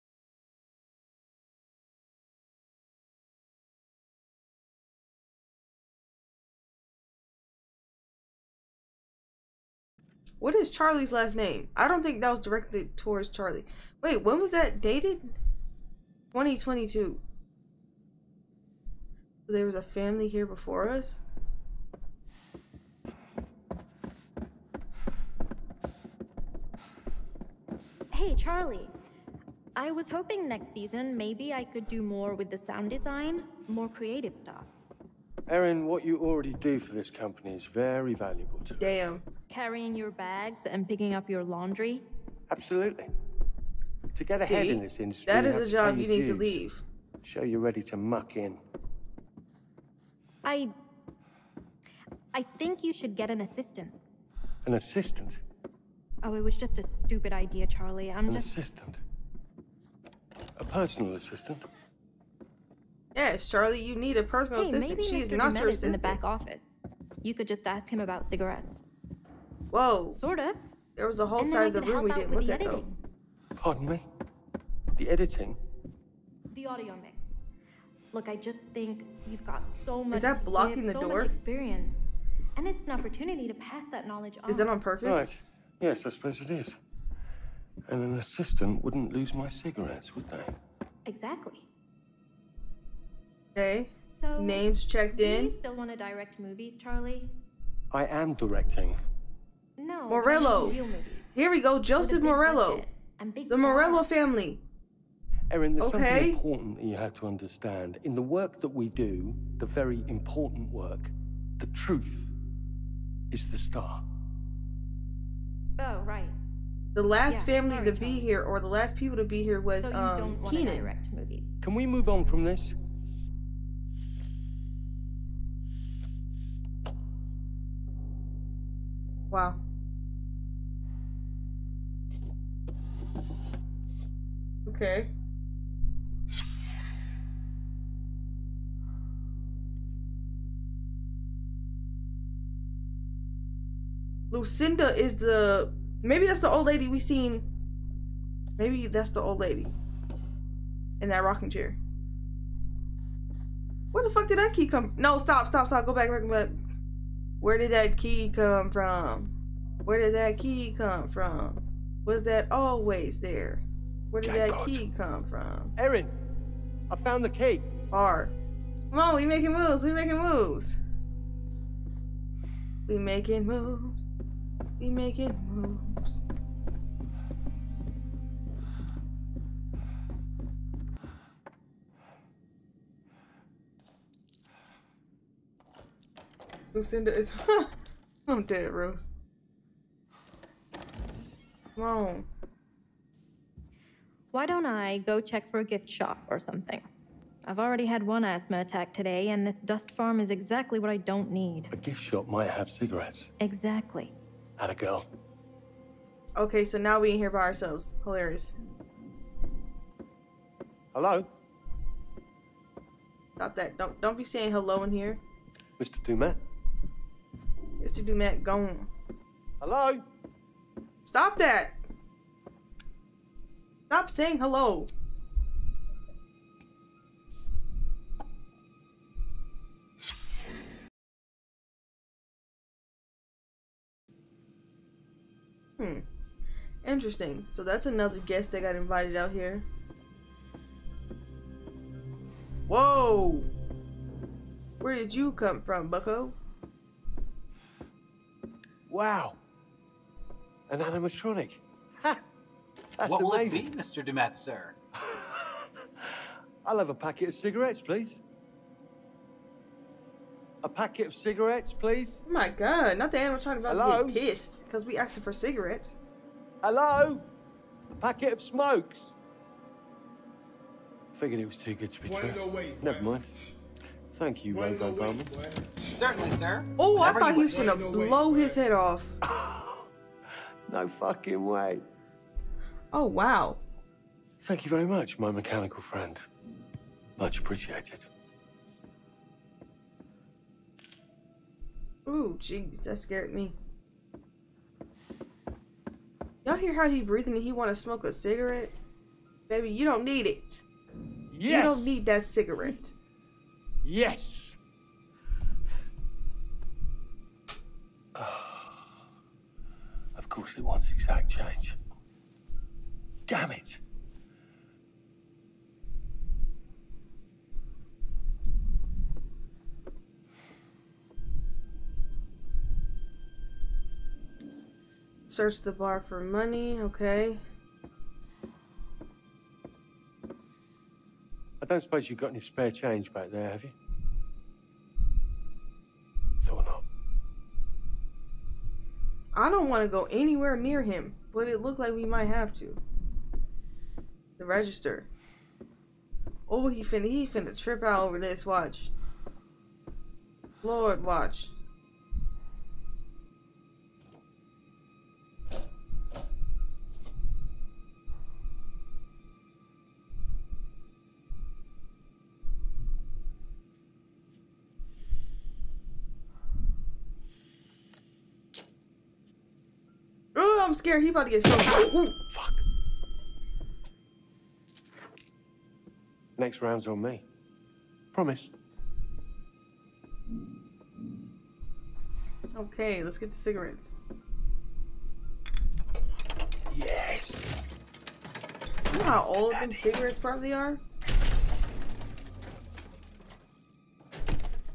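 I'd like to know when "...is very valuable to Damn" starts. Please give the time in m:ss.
0:37.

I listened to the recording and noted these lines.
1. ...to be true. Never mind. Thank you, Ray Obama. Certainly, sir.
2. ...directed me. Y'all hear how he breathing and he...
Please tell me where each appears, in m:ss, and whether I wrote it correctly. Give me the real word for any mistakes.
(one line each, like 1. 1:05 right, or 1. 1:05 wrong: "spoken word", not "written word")
1. 4:31 right
2. 4:52 wrong: "scared", not "directed".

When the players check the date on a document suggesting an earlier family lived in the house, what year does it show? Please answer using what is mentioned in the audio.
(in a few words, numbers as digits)
2022.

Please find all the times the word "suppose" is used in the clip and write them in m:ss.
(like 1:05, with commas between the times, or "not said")
1:26, 5:31.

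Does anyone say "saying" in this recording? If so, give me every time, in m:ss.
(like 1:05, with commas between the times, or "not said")
3:34, 3:44.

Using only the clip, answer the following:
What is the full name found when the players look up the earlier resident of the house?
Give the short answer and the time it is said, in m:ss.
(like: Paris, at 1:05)
Joseph Morello, at 1:41.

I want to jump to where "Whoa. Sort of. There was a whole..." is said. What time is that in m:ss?
1:09.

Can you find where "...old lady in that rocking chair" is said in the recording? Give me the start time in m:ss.
2:29.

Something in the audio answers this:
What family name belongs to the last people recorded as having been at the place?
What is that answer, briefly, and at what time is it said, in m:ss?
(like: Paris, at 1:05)
Keenan, at 2:00.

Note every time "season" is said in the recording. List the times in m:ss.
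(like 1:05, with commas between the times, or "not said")
0:30.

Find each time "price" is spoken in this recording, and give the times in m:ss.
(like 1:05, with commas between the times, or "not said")
not said.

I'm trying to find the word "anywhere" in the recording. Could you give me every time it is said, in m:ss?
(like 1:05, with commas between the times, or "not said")
5:40.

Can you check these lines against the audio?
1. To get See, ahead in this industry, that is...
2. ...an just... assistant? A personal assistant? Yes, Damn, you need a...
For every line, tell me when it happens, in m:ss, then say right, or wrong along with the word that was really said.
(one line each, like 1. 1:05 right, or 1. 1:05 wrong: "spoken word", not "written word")
1. 0:44 right
2. 0:58 wrong: "Charlie", not "Damn".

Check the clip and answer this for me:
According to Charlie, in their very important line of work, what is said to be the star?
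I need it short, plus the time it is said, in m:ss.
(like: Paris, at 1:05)
the truth, at 1:51.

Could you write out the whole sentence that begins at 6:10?
I'm scared he about to get so.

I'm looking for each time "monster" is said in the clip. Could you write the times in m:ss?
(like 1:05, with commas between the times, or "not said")
not said.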